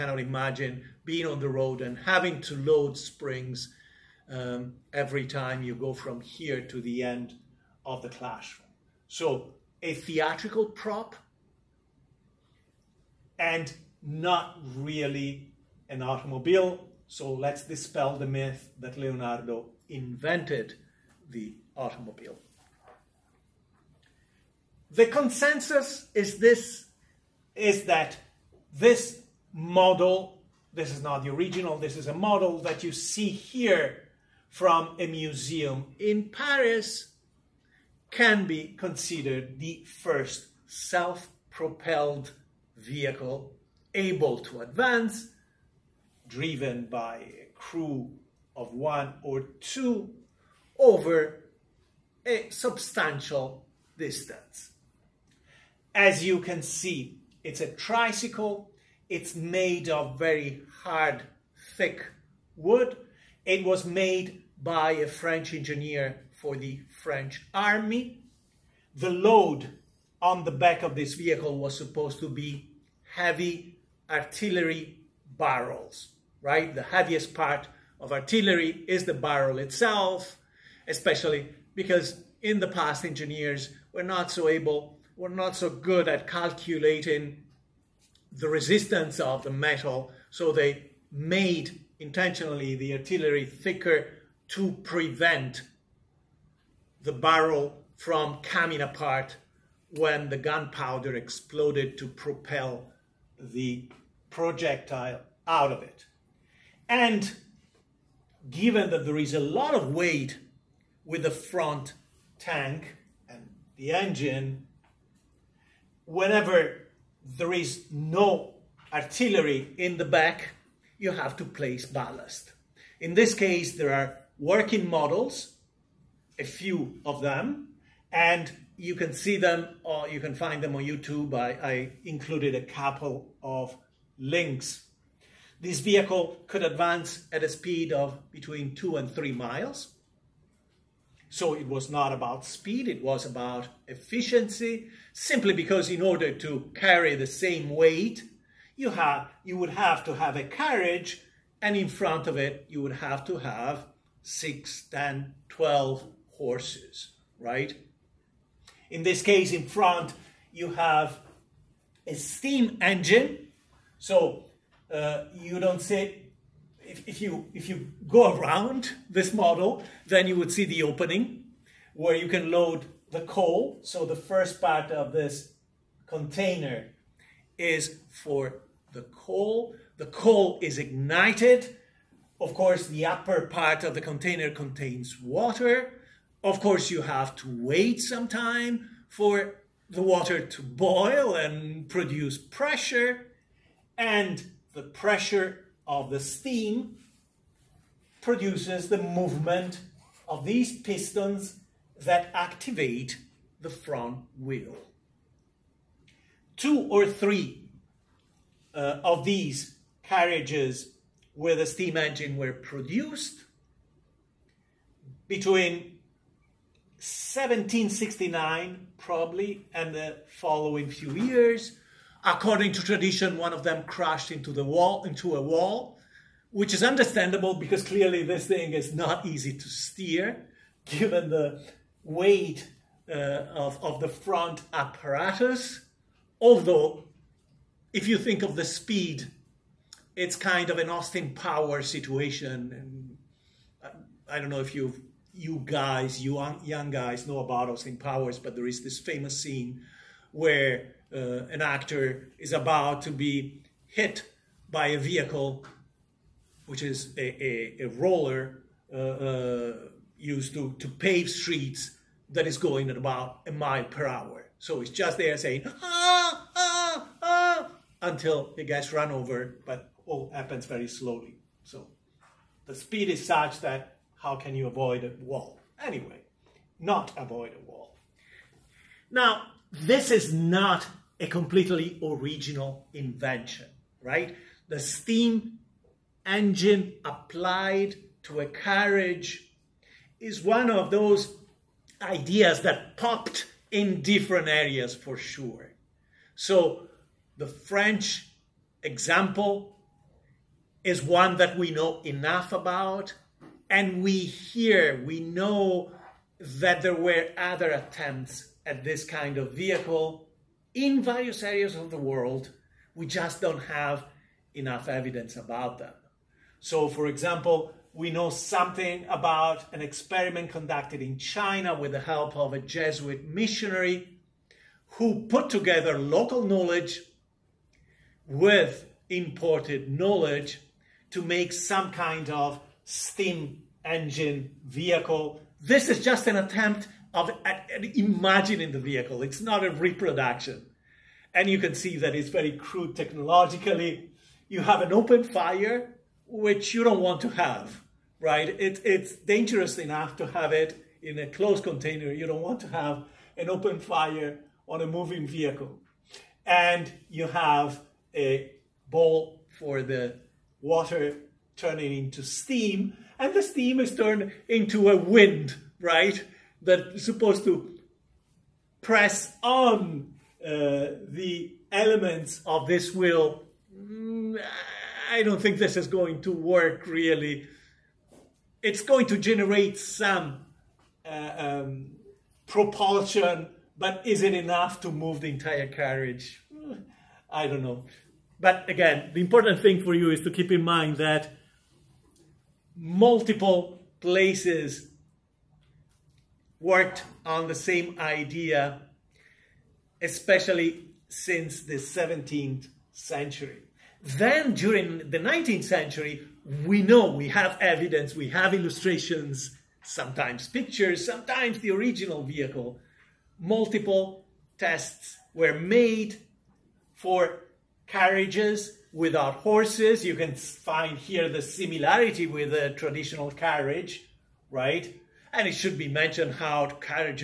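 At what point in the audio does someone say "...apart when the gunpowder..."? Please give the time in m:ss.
1:38.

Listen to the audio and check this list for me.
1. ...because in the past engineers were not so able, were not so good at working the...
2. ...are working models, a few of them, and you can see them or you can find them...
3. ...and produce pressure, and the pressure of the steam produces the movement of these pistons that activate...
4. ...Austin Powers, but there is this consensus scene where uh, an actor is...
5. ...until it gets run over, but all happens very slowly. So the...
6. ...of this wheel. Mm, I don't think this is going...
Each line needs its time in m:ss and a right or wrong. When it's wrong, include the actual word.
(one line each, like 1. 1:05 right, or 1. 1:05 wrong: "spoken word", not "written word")
1. 1:21 wrong: "calculating", not "working"
2. 2:03 right
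3. 3:11 right
4. 4:07 wrong: "famous", not "consensus"
5. 4:28 right
6. 6:12 right.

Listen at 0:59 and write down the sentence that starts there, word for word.
It's made of very hard, thick wood.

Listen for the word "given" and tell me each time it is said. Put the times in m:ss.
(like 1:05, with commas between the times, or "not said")
1:48, 3:50.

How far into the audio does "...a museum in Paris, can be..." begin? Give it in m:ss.
0:34.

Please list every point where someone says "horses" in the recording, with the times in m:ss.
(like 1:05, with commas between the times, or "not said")
2:36, 6:59.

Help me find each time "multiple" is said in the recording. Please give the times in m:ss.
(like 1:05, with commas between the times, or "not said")
6:32, 6:53.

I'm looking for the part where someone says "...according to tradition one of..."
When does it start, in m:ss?
3:42.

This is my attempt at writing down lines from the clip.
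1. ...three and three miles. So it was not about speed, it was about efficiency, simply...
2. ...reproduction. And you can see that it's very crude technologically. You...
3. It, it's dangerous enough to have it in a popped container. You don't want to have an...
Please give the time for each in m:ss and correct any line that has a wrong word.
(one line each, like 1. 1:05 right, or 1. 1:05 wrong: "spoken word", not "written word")
1. 2:18 wrong: "two", not "three"
2. 5:39 right
3. 5:48 wrong: "closed", not "popped".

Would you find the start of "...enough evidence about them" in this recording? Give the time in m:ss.
5:14.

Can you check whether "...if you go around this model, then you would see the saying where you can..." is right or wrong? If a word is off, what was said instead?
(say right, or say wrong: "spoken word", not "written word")
wrong: "opening", not "saying".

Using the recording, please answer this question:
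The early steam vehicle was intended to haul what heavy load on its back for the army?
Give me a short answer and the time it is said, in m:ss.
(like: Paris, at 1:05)
Artillery barrels, at 1:14.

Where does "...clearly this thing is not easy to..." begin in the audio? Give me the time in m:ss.
3:47.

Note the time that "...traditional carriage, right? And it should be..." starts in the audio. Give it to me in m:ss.
7:02.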